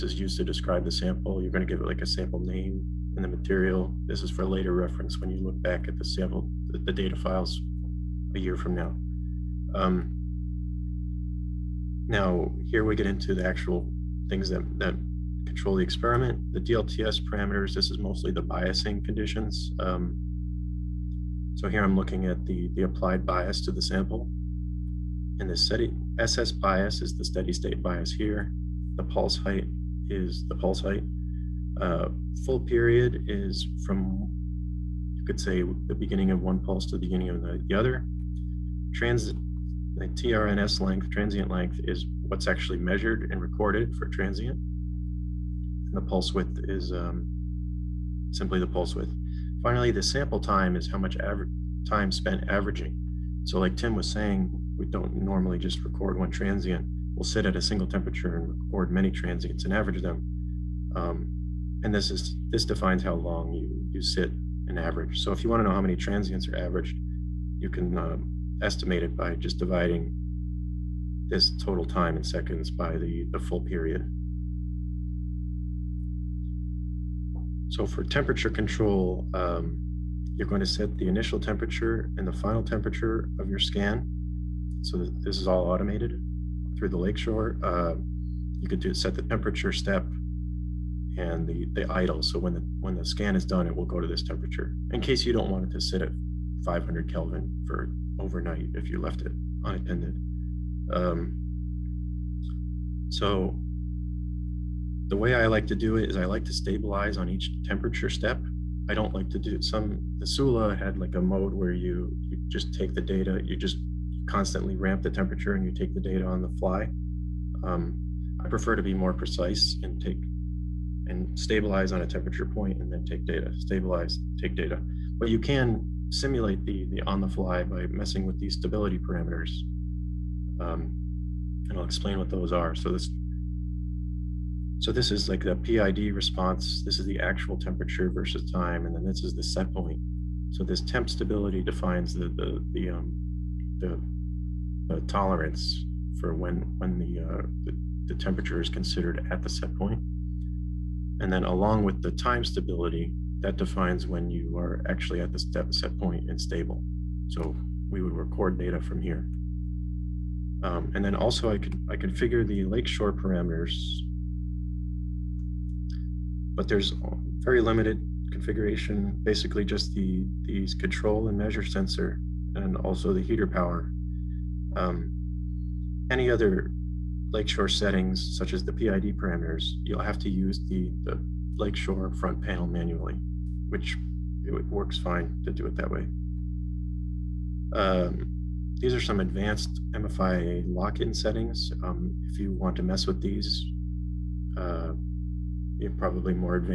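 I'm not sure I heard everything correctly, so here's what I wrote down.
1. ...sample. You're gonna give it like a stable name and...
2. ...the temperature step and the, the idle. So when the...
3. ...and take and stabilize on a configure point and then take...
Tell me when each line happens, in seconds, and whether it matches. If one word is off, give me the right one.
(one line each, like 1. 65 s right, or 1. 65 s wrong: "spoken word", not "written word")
1. 0 s wrong: "sample", not "stable"
2. 89 s right
3. 119 s wrong: "temperature", not "configure".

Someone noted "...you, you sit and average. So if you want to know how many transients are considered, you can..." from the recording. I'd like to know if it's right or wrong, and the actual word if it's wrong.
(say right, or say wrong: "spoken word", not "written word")
wrong: "averaged", not "considered".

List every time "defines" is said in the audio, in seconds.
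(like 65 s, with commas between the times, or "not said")
62 s, 141 s, 153 s.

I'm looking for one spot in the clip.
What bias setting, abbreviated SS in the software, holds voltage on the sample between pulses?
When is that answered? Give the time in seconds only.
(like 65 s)
27 s.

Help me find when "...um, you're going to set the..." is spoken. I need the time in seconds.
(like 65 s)
79 s.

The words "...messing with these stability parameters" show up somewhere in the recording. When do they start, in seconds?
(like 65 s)
127 s.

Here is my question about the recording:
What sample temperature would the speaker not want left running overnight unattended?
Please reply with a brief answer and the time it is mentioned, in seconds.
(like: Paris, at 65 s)
500 Kelvin, at 96 s.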